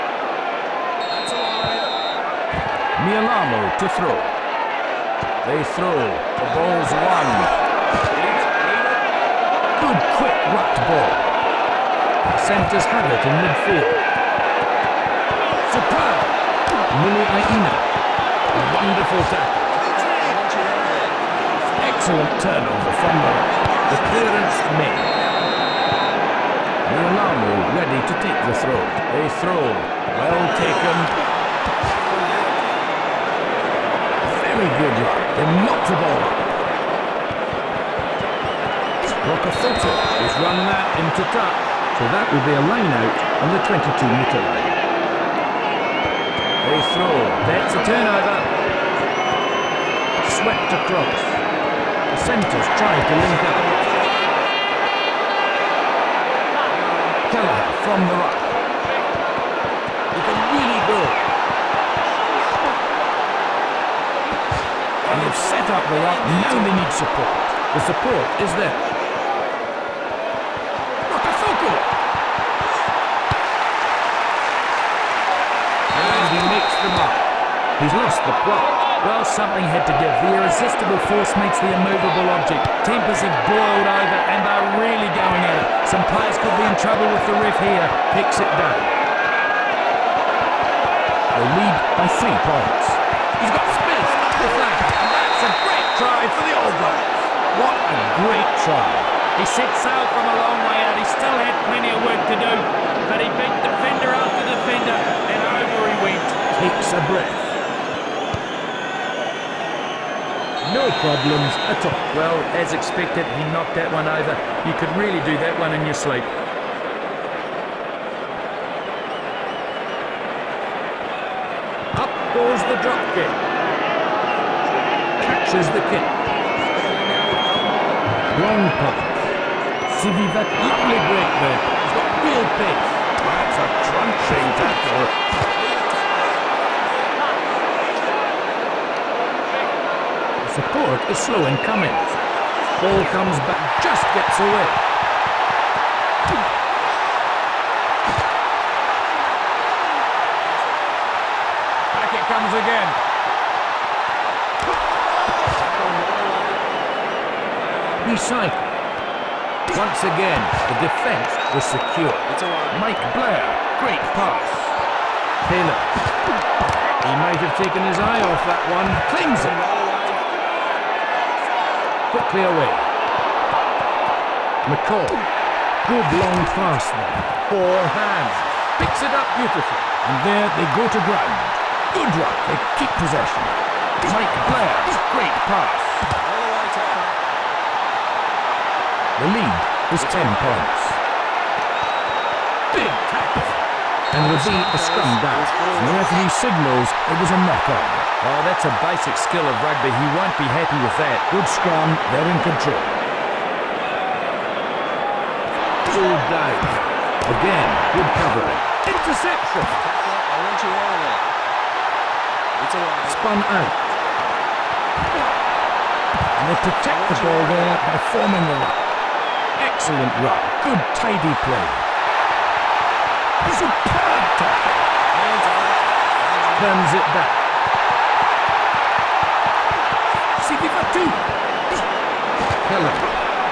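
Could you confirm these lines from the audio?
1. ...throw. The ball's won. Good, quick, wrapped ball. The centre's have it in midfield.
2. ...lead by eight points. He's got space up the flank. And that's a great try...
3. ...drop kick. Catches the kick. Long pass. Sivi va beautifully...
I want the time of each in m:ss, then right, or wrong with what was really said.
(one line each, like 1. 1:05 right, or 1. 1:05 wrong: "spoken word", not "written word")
1. 0:05 right
2. 1:31 wrong: "three", not "eight"
3. 2:02 wrong: "equally", not "beautifully".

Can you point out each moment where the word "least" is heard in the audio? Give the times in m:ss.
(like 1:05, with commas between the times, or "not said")
not said.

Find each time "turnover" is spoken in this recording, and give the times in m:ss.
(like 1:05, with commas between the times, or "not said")
0:22, 0:47.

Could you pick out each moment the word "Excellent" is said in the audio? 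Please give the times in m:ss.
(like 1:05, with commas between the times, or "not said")
0:21, 3:39.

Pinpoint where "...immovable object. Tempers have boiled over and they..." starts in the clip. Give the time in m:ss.
1:21.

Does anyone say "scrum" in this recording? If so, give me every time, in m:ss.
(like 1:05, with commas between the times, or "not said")
3:14, 3:21.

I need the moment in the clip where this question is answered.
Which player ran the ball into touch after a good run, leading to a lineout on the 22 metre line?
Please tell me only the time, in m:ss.
0:39.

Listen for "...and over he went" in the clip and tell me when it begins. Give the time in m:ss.
1:44.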